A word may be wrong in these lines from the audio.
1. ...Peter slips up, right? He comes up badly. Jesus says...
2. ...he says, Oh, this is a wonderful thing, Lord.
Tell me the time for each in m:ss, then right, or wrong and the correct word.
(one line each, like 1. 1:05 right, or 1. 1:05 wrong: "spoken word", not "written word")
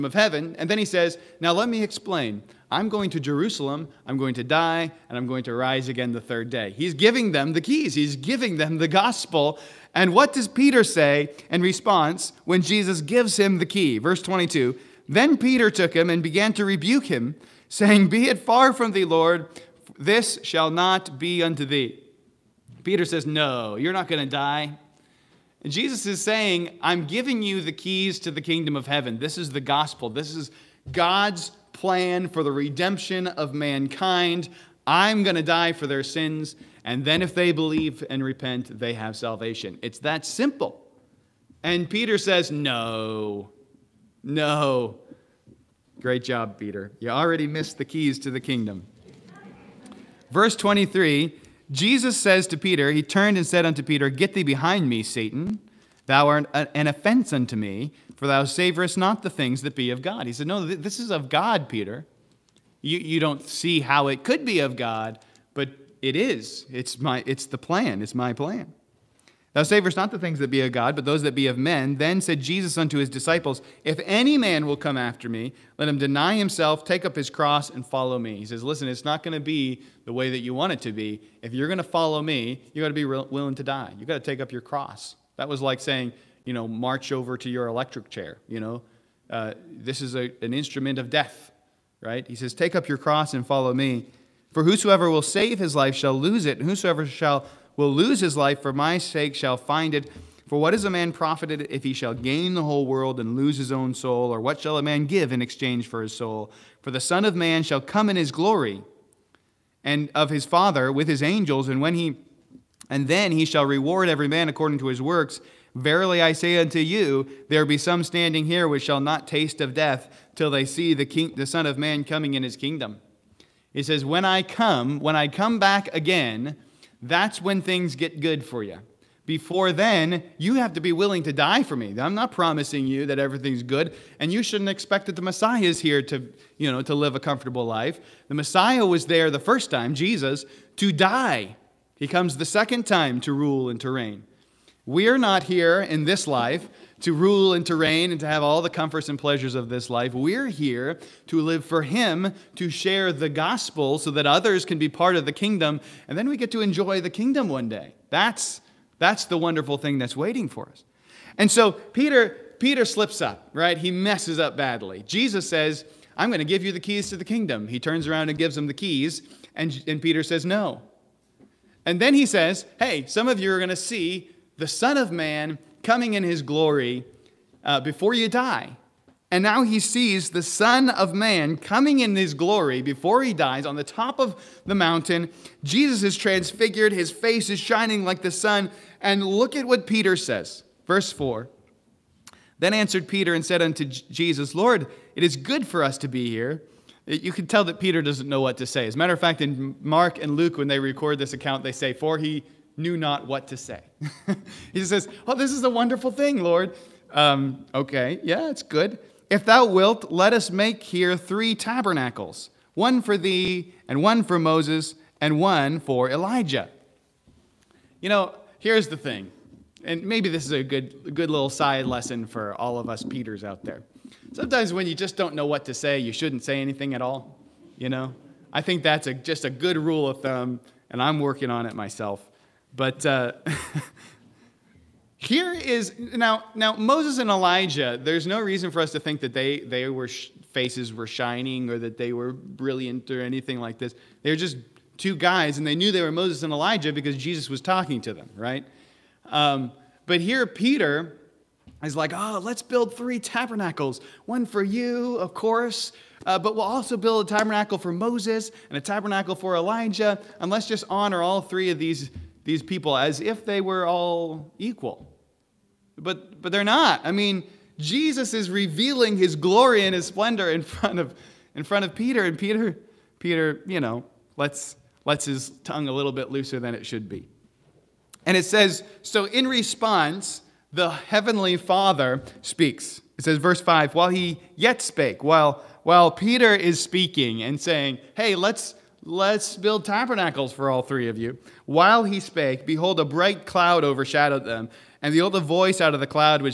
1. 2:42 wrong: "messes", not "comes"
2. 3:24 right.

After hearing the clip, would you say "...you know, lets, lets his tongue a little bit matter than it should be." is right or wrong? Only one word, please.
wrong.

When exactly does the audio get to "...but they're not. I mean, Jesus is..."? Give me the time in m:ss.
4:26.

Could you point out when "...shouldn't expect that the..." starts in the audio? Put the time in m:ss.
2:14.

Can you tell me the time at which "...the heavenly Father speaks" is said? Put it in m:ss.
4:40.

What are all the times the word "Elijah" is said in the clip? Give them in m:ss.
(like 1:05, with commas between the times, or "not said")
3:36, 3:57, 4:06, 4:19.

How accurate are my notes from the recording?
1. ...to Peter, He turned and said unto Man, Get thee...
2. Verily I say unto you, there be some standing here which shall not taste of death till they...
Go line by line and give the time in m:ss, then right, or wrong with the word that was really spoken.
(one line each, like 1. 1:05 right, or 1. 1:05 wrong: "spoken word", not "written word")
1. 0:52 wrong: "Peter", not "Man"
2. 1:55 right.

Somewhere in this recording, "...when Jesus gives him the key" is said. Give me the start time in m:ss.
0:12.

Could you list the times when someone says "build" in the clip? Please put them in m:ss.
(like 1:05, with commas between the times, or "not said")
4:12, 4:16, 4:49.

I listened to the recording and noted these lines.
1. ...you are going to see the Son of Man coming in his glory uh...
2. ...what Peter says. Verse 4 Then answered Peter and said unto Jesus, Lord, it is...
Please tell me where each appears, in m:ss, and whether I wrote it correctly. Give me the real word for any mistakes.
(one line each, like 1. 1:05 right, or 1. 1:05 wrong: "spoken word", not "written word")
1. 2:53 right
2. 3:09 right.